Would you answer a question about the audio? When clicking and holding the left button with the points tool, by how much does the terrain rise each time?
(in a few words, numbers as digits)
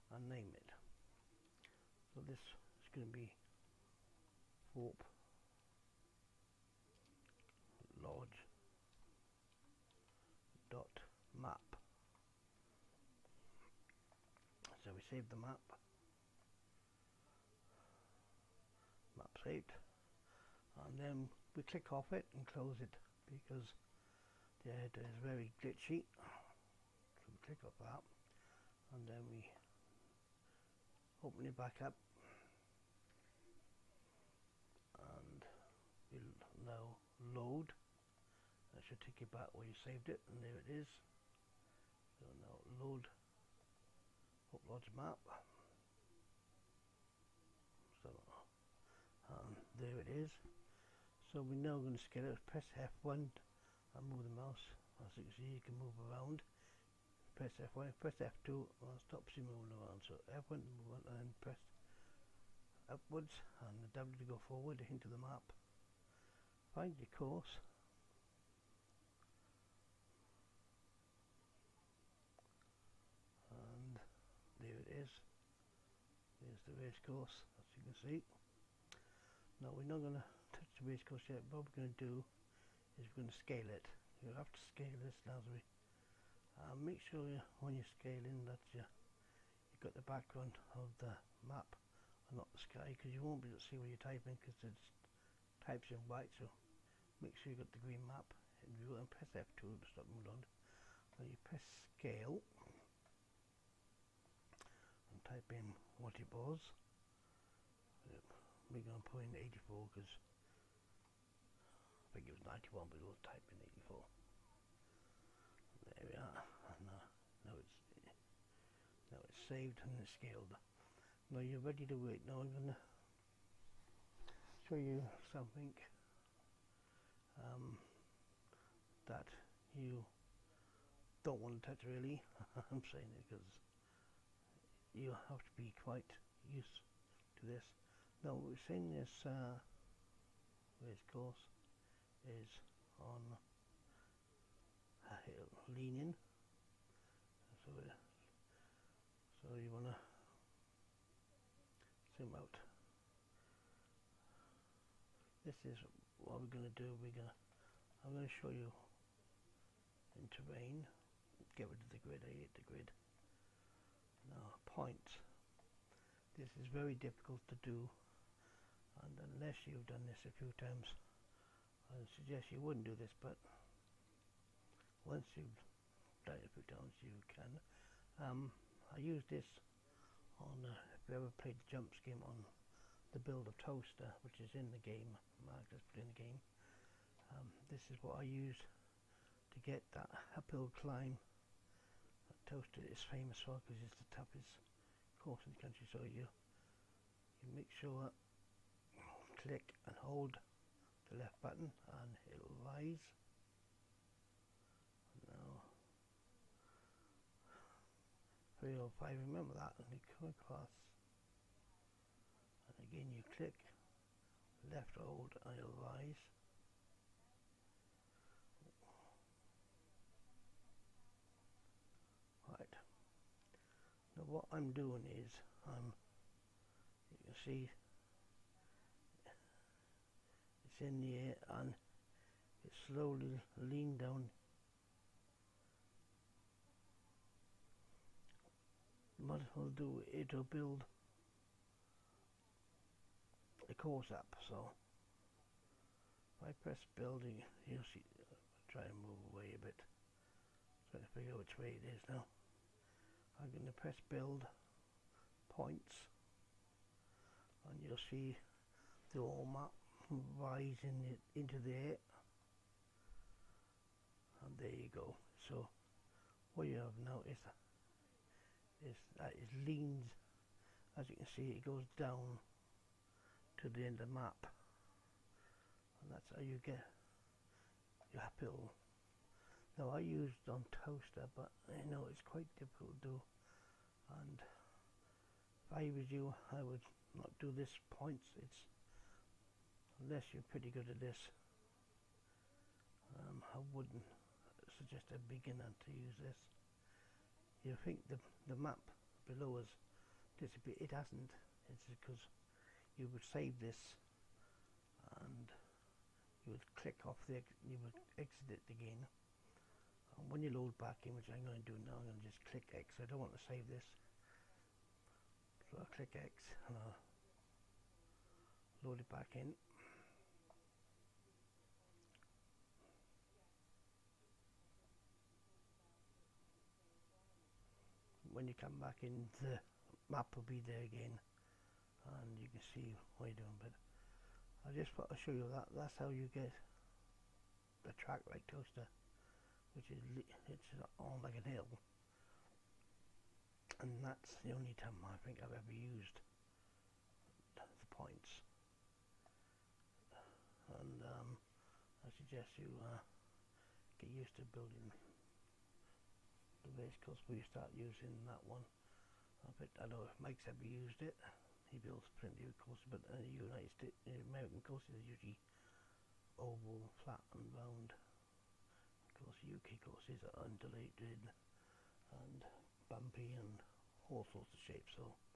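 5.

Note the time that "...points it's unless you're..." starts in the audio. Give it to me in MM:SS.
04:47.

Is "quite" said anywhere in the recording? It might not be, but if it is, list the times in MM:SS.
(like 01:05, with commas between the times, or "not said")
02:15, 04:42.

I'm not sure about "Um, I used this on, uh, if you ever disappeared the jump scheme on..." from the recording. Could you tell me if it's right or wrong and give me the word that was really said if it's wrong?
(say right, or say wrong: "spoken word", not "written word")
wrong: "played", not "disappeared".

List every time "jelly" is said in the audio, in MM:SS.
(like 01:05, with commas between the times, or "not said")
not said.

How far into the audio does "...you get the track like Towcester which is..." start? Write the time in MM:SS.
05:36.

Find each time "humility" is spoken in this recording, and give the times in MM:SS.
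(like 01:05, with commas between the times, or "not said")
not said.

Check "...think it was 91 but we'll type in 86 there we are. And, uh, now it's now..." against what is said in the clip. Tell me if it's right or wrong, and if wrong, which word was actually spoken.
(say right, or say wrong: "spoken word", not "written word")
wrong: "84", not "86".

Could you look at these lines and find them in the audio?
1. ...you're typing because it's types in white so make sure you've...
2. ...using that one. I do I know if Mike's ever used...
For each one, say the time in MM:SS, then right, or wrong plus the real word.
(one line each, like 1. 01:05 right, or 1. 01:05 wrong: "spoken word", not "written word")
1. 01:33 right
2. 05:57 right.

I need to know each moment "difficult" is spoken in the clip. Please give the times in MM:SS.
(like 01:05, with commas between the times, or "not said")
02:46, 04:42.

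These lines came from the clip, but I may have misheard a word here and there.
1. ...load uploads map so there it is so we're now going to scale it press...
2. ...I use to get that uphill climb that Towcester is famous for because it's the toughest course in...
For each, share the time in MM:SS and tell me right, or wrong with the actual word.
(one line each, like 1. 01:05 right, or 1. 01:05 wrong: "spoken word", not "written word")
1. 00:42 right
2. 03:08 right.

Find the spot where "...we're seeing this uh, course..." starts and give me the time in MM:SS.
02:18.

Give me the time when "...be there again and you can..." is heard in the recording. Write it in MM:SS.
05:30.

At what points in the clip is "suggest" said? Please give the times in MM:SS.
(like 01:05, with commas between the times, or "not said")
02:52, 04:54, 05:52.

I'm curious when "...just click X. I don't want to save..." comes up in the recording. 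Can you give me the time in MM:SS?
05:12.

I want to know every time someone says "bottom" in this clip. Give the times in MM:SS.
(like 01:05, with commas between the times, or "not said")
not said.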